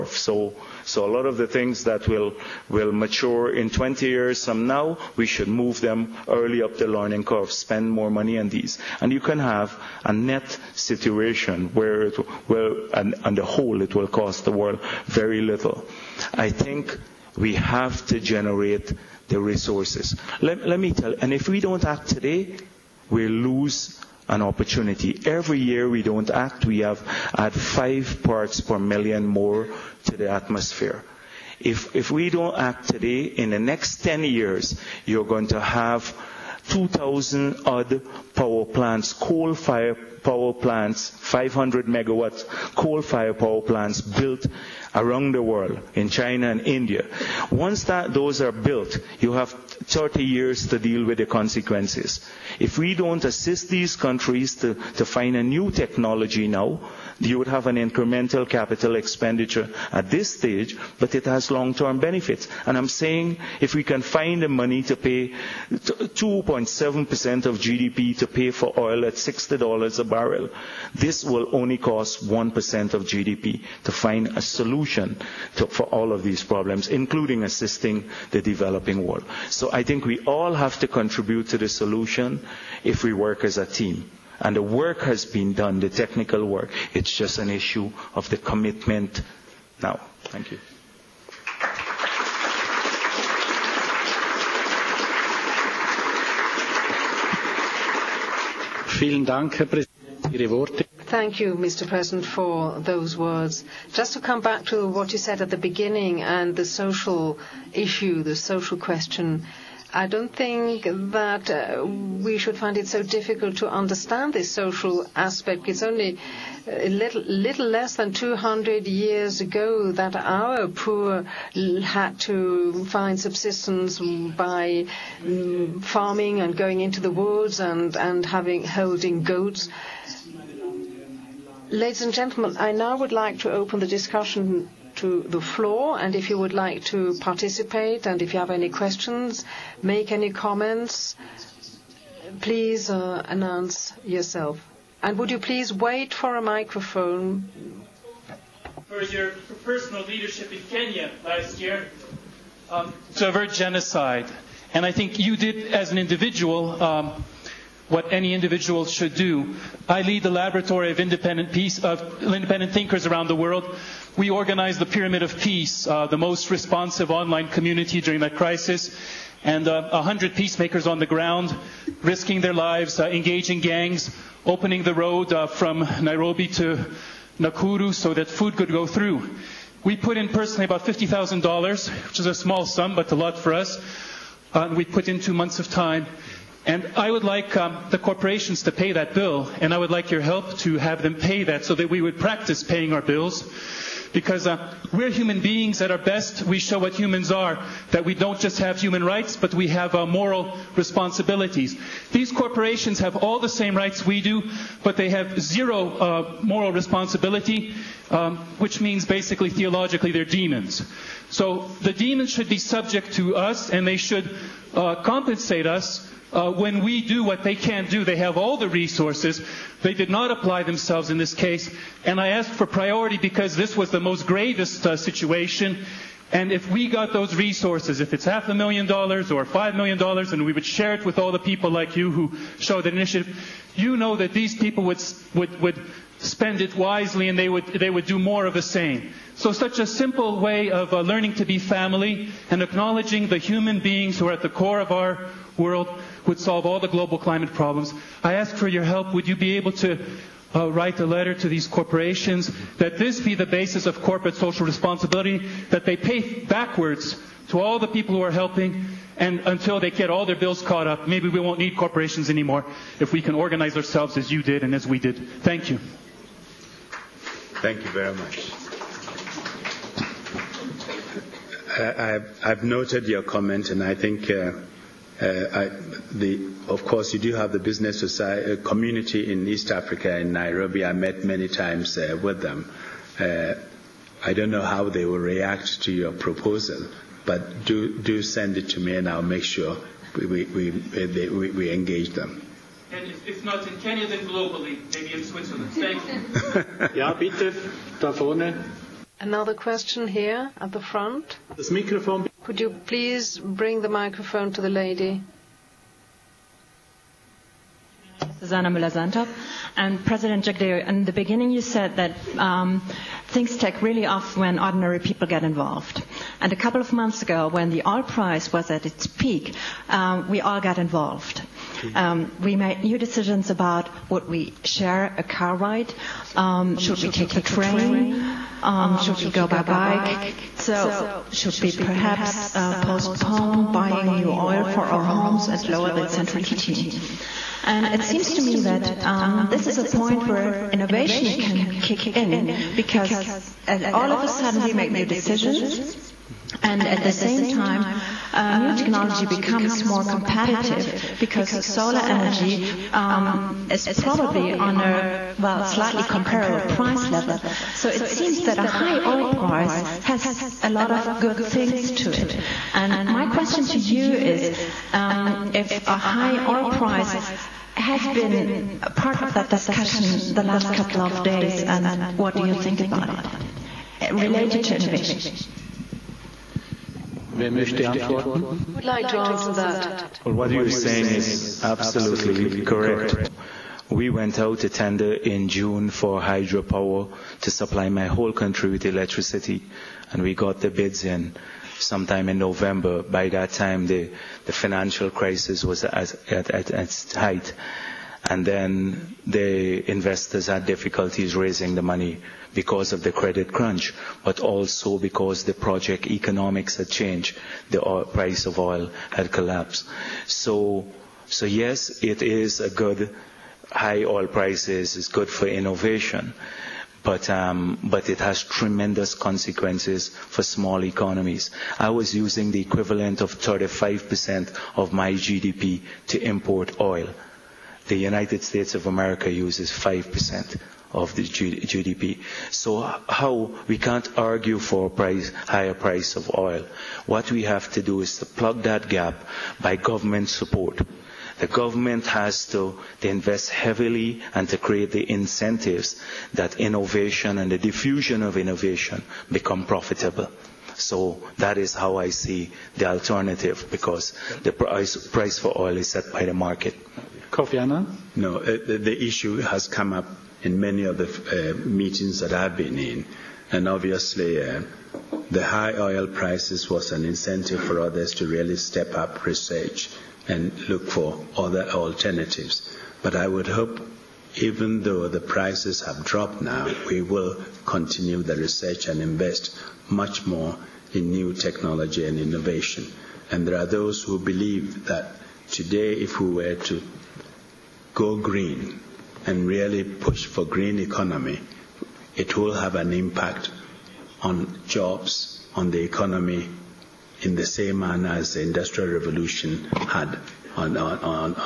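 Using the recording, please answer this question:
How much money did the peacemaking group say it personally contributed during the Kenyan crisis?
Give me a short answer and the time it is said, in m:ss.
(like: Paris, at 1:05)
$50,000, at 3:00.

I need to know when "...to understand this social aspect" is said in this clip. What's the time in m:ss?
1:53.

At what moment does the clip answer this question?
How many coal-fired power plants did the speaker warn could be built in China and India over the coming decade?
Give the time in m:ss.
0:36.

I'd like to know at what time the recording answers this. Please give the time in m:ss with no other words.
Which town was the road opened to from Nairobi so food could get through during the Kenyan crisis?
2:57.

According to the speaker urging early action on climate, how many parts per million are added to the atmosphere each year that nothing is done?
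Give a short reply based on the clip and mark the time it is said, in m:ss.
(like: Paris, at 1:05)
5, at 0:27.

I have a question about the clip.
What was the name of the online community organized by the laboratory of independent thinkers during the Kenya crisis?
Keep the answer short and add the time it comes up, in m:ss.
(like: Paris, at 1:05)
Pyramid of Peace, at 2:44.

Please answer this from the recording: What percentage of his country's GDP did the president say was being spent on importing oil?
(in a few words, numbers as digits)
35%.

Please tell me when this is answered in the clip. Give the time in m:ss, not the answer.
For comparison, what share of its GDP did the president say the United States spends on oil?
7:09.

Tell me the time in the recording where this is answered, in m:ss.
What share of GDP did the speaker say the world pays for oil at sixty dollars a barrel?
1:05.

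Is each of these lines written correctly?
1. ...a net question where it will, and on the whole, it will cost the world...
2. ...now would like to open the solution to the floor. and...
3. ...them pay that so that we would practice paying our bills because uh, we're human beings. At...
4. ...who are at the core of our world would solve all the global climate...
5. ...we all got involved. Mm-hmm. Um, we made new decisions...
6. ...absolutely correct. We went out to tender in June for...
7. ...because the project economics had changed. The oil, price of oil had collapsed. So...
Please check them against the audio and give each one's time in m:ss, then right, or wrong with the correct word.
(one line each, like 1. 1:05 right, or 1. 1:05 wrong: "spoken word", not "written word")
1. 0:10 wrong: "situation", not "question"
2. 2:12 wrong: "discussion", not "solution"
3. 3:11 right
4. 4:04 right
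5. 5:20 right
6. 6:21 right
7. 6:44 right.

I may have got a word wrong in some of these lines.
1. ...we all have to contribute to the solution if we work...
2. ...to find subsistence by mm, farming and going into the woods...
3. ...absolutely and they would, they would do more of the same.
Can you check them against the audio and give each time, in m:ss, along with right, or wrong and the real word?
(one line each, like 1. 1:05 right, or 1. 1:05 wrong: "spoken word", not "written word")
1. 1:20 right
2. 2:02 right
3. 3:56 wrong: "wisely", not "absolutely".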